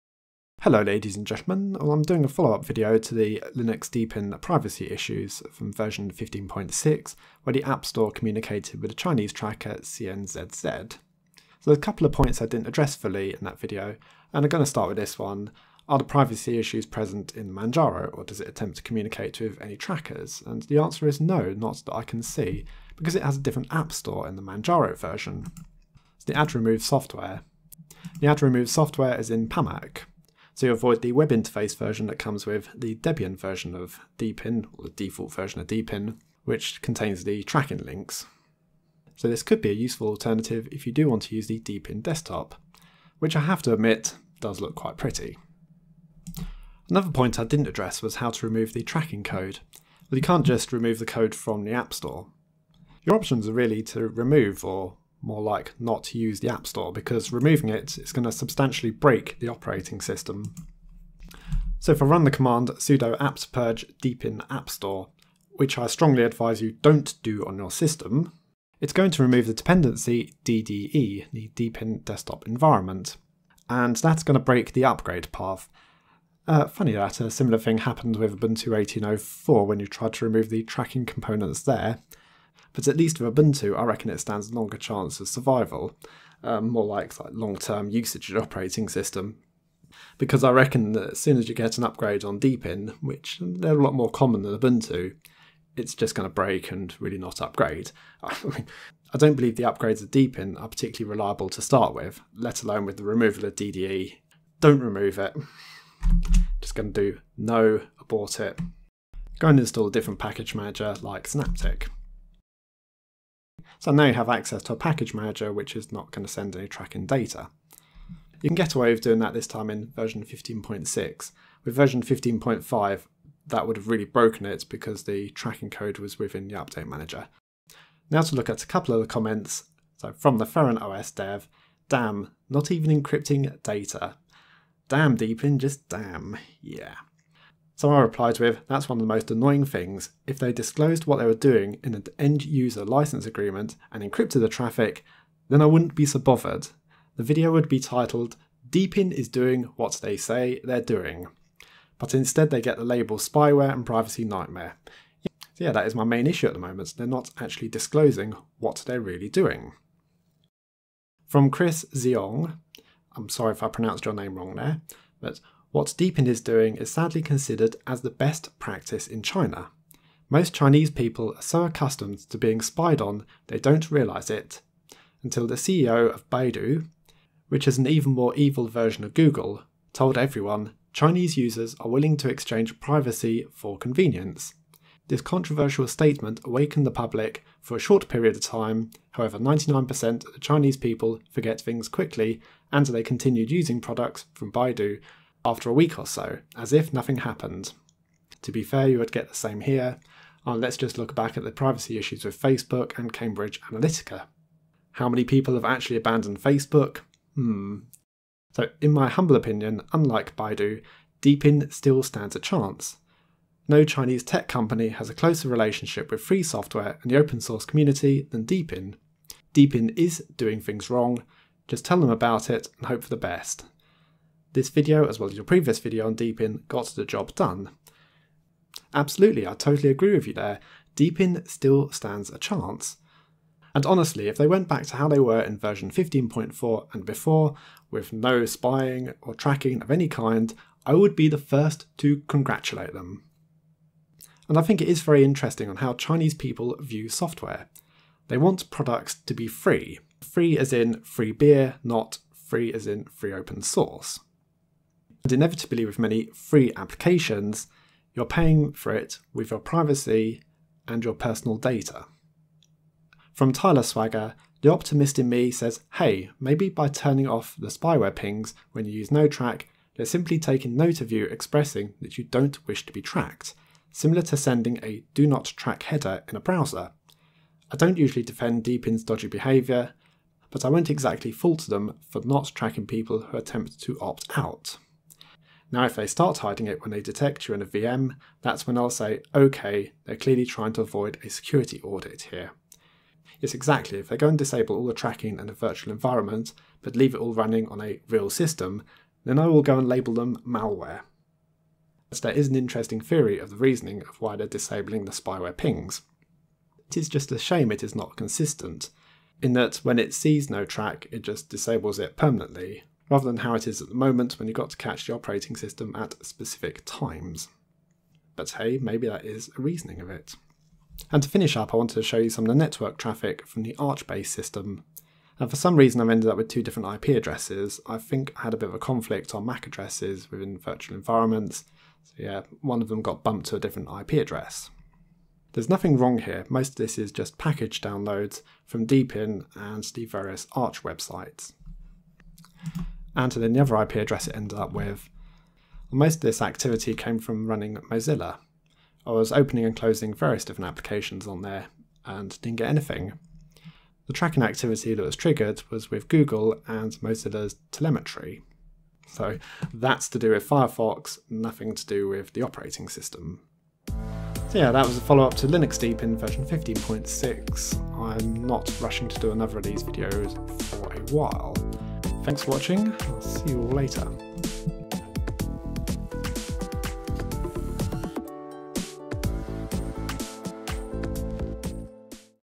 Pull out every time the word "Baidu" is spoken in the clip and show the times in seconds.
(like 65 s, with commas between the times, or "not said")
176 s, 194 s, 210 s.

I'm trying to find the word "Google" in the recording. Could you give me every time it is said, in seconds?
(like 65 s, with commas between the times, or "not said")
179 s, 356 s.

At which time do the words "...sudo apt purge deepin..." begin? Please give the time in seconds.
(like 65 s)
62 s.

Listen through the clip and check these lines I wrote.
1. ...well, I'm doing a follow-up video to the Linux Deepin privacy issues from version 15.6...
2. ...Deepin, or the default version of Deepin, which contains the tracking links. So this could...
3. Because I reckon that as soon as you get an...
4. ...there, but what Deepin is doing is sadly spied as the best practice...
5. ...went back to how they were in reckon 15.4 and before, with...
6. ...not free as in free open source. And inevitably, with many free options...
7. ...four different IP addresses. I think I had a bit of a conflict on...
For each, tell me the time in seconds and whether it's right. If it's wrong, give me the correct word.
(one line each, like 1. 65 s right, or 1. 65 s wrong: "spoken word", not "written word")
1. 1 s right
2. 34 s right
3. 90 s right
4. 164 s wrong: "considered", not "spied"
5. 234 s wrong: "version", not "reckon"
6. 251 s wrong: "applications", not "options"
7. 326 s wrong: "two", not "four".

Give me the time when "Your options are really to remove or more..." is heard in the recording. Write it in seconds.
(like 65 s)
53 s.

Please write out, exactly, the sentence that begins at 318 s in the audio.
But hey, maybe that is a reasoning of it.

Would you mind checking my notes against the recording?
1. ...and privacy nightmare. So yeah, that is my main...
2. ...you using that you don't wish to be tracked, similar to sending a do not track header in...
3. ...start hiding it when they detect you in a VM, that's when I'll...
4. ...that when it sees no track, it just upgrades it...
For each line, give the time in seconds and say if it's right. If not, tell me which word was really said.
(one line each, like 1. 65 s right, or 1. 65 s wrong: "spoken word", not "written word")
1. 153 s right
2. 271 s wrong: "expressing", not "using"
3. 286 s right
4. 309 s wrong: "disables", not "upgrades".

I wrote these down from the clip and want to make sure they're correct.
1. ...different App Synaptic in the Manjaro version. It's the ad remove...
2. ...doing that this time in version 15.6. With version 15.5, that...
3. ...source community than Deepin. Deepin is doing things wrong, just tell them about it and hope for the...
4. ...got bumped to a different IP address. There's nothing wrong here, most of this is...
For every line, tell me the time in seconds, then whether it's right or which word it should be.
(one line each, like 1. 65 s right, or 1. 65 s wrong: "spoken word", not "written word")
1. 23 s wrong: "Store", not "Synaptic"
2. 119 s right
3. 217 s right
4. 333 s right.